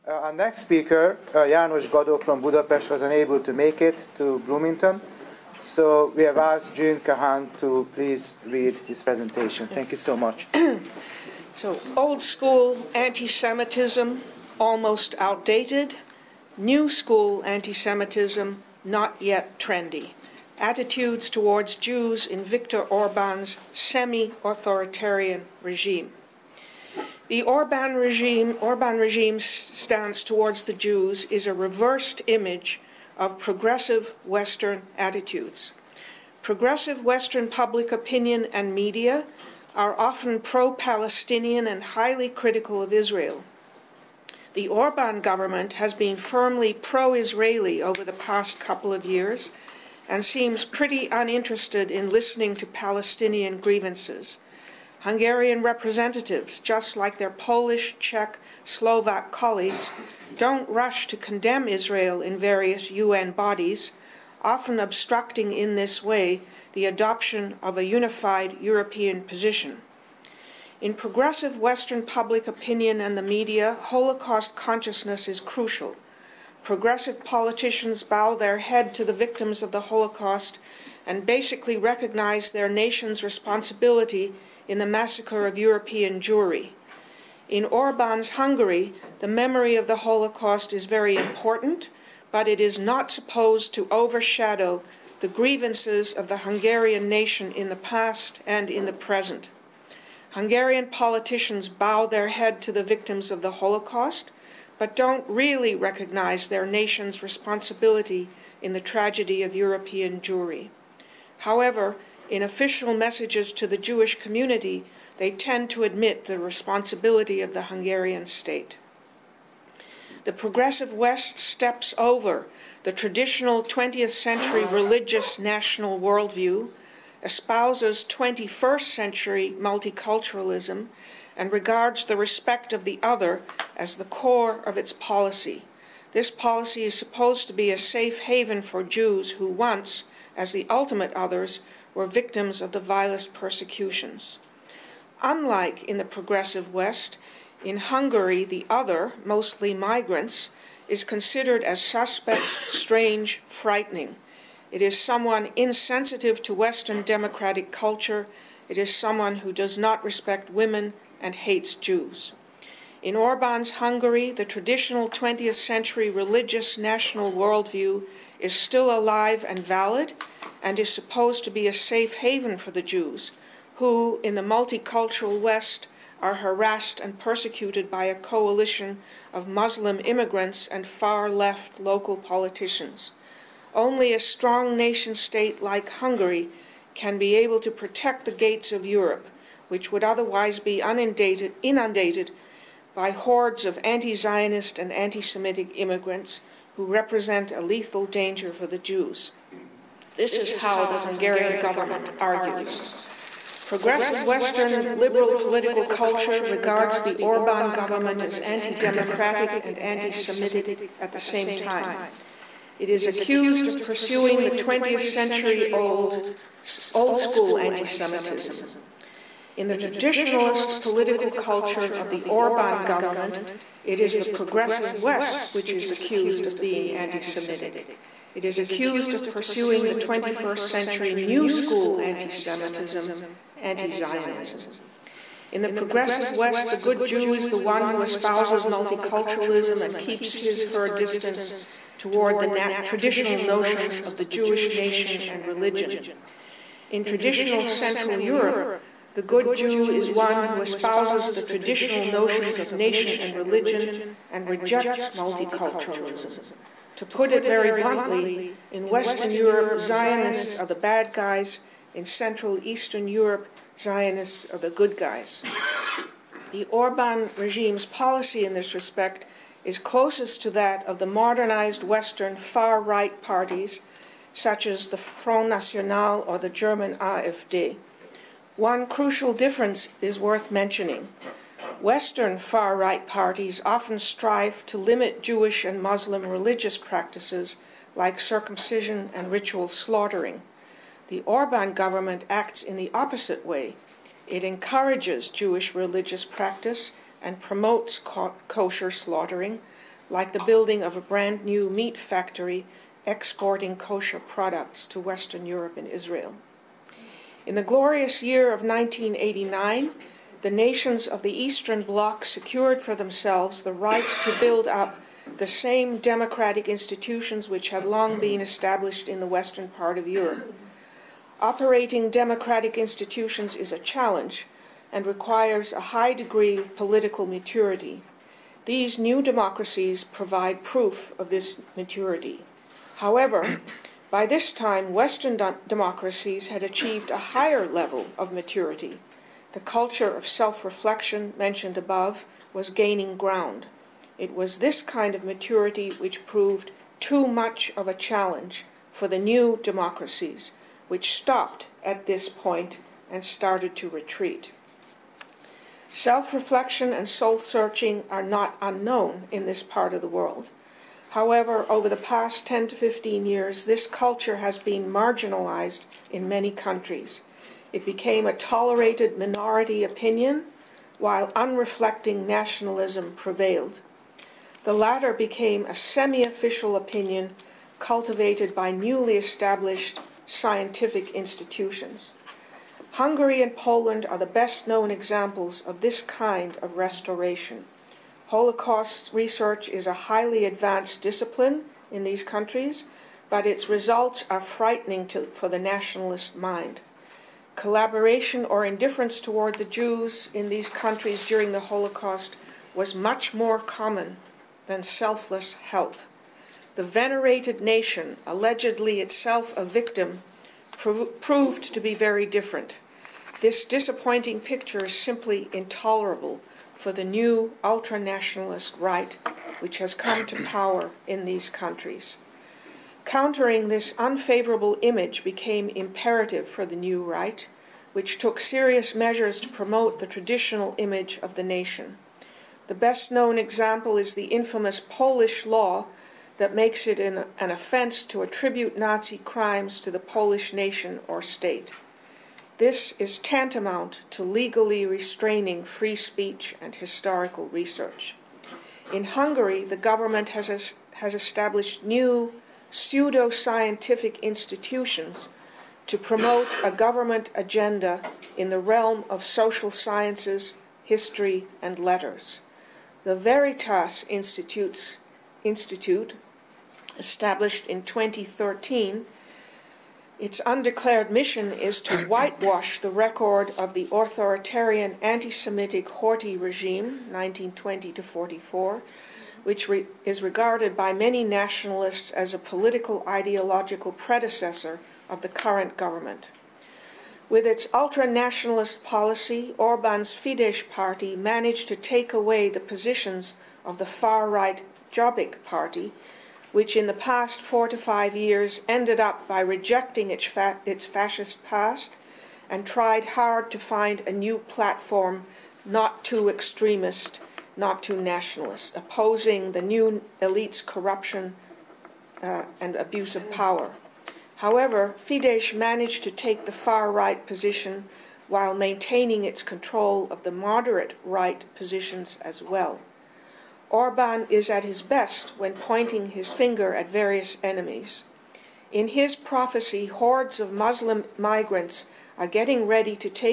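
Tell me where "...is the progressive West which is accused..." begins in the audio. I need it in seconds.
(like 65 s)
224 s.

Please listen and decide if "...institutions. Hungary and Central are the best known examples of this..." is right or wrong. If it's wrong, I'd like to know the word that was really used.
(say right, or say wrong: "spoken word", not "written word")
wrong: "Poland", not "Central".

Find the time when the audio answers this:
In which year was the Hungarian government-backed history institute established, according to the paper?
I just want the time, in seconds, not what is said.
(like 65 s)
467 s.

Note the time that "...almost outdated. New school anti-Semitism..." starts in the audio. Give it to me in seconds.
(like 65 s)
14 s.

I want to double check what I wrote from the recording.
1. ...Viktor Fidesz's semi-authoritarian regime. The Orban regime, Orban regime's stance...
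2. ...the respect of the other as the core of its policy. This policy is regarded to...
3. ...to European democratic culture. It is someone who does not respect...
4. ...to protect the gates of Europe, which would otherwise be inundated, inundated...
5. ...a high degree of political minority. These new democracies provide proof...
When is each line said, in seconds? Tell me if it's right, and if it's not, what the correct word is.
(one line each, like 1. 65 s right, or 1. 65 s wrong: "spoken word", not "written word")
1. 22 s wrong: "Orban", not "Fidesz"
2. 132 s wrong: "supposed", not "regarded"
3. 156 s wrong: "Western", not "European"
4. 187 s right
5. 325 s wrong: "maturity", not "minority".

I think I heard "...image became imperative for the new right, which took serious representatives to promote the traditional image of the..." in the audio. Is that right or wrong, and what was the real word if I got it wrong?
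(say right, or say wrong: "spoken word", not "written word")
wrong: "measures", not "representatives".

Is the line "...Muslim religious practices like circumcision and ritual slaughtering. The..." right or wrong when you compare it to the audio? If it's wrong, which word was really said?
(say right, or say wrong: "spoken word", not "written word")
right.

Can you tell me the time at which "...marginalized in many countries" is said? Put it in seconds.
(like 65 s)
364 s.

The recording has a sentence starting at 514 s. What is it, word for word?
However, Fidesz managed to take the far right position while maintaining its control of the moderate right positions as well.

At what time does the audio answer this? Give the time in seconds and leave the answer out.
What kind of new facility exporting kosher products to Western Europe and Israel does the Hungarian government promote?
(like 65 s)
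301 s.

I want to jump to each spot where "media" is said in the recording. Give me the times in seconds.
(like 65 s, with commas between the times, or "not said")
38 s, 73 s.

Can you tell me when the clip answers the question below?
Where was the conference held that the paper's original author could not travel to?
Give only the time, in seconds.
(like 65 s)
4 s.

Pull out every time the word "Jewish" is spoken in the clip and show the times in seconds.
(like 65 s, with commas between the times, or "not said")
113 s, 244 s, 285 s, 295 s.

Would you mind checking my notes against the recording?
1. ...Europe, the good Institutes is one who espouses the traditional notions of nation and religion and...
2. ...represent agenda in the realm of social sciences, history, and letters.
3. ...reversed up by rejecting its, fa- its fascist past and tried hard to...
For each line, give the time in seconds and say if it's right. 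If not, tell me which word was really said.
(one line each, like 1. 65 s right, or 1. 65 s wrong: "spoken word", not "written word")
1. 248 s wrong: "Jew", not "Institutes"
2. 456 s wrong: "government", not "represent"
3. 498 s wrong: "ended", not "reversed".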